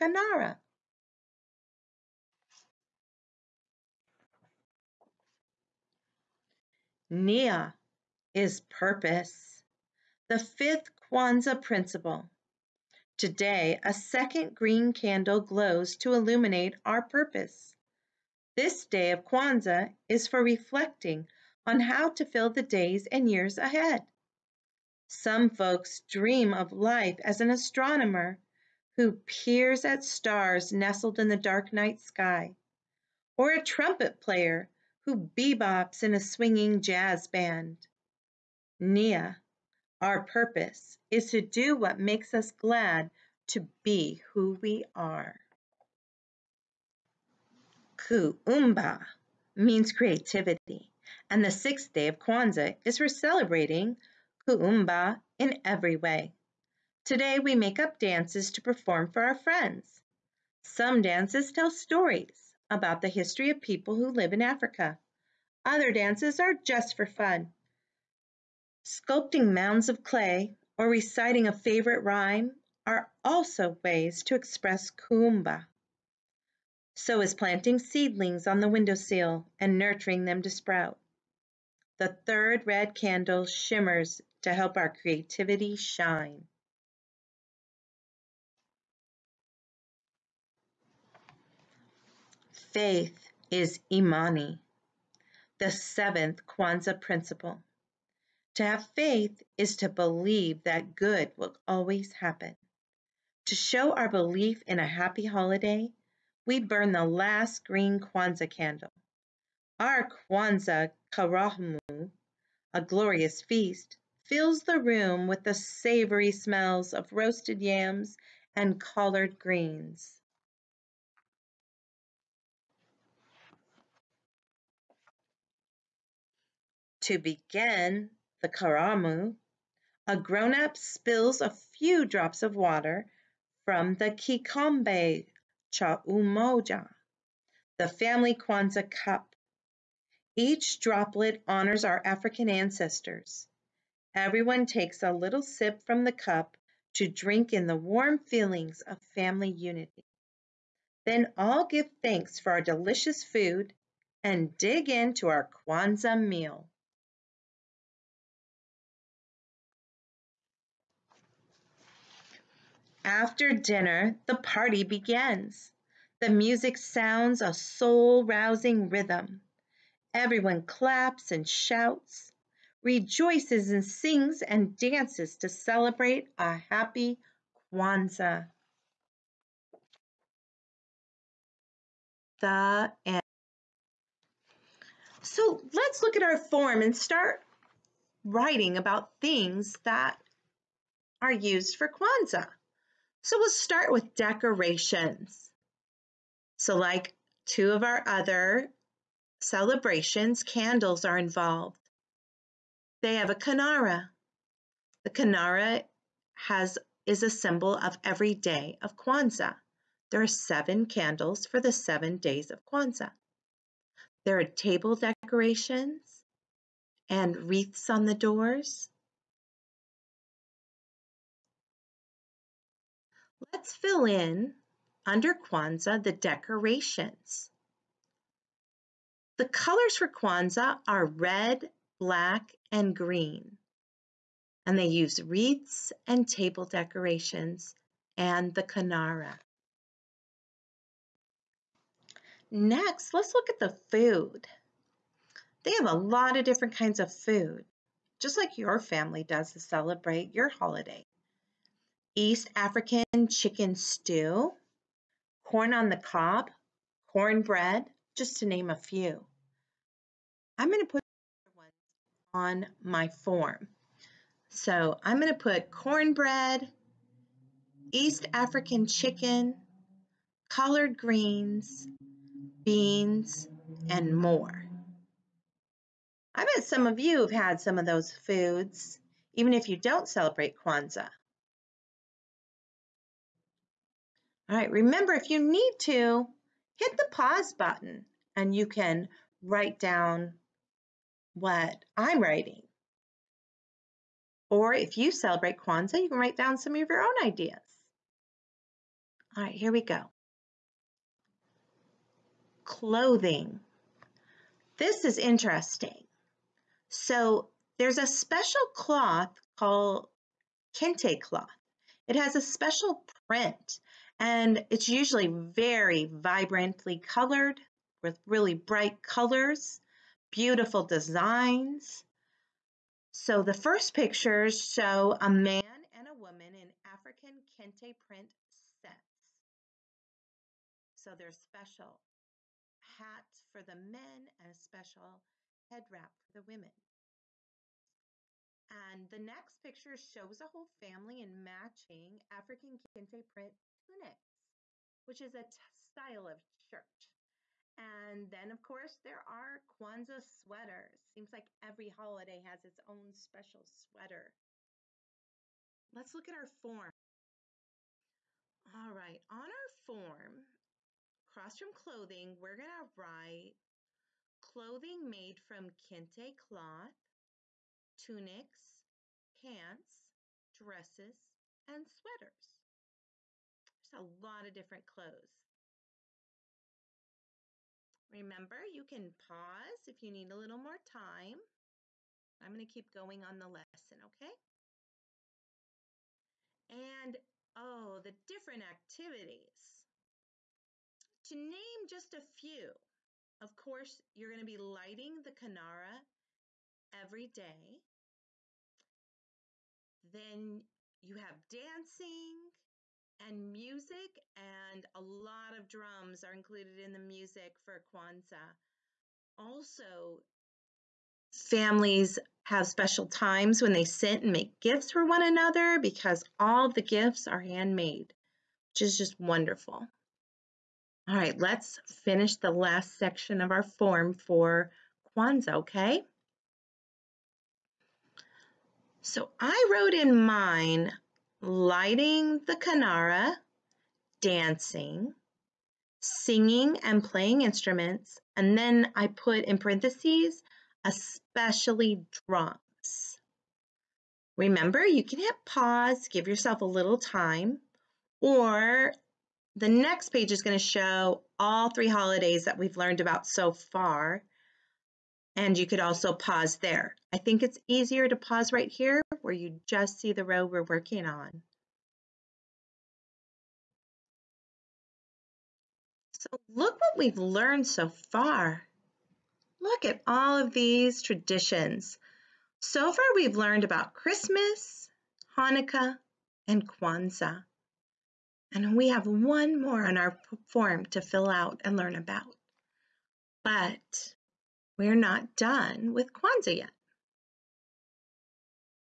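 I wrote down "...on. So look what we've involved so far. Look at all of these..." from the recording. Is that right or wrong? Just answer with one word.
wrong.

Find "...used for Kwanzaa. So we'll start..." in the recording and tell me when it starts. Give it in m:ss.
3:11.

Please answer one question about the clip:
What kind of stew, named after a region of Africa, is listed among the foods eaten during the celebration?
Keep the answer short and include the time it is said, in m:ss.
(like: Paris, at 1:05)
East African chicken stew, at 4:12.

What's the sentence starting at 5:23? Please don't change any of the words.
So the first pictures show a man and a woman in African kente print sets.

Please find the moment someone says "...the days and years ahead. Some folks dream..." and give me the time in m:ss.
0:22.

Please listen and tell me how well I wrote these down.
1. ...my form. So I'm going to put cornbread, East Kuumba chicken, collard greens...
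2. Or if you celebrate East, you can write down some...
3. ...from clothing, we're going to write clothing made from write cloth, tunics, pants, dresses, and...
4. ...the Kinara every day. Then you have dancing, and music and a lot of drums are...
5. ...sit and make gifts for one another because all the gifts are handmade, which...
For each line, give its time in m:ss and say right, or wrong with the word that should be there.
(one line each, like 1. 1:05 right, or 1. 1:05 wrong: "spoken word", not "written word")
1. 4:22 wrong: "African", not "Kuumba"
2. 4:54 wrong: "Kwanzaa", not "East"
3. 6:01 wrong: "kente", not "write"
4. 6:35 right
5. 6:53 right.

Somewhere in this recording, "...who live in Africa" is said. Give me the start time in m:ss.
1:03.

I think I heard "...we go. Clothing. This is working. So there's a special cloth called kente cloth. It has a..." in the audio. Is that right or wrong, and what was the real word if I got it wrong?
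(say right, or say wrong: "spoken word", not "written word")
wrong: "interesting", not "working".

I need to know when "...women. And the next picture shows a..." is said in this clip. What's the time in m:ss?
5:36.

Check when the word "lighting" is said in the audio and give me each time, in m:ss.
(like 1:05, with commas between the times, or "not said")
6:34, 7:11.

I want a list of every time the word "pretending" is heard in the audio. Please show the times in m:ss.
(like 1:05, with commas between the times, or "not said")
not said.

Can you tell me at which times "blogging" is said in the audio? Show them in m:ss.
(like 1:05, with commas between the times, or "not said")
not said.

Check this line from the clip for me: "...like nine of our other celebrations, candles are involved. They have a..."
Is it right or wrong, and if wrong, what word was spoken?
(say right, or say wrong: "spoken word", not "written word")
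wrong: "two", not "nine".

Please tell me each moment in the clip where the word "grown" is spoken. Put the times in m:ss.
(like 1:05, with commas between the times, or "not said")
2:10.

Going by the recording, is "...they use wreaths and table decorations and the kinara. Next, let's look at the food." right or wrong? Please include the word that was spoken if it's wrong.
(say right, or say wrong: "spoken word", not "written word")
right.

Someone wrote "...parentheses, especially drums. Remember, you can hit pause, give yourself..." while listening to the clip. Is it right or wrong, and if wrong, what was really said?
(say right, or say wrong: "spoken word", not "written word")
right.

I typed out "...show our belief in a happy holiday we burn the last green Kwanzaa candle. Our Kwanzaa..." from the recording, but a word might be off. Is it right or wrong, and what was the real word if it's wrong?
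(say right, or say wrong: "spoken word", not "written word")
right.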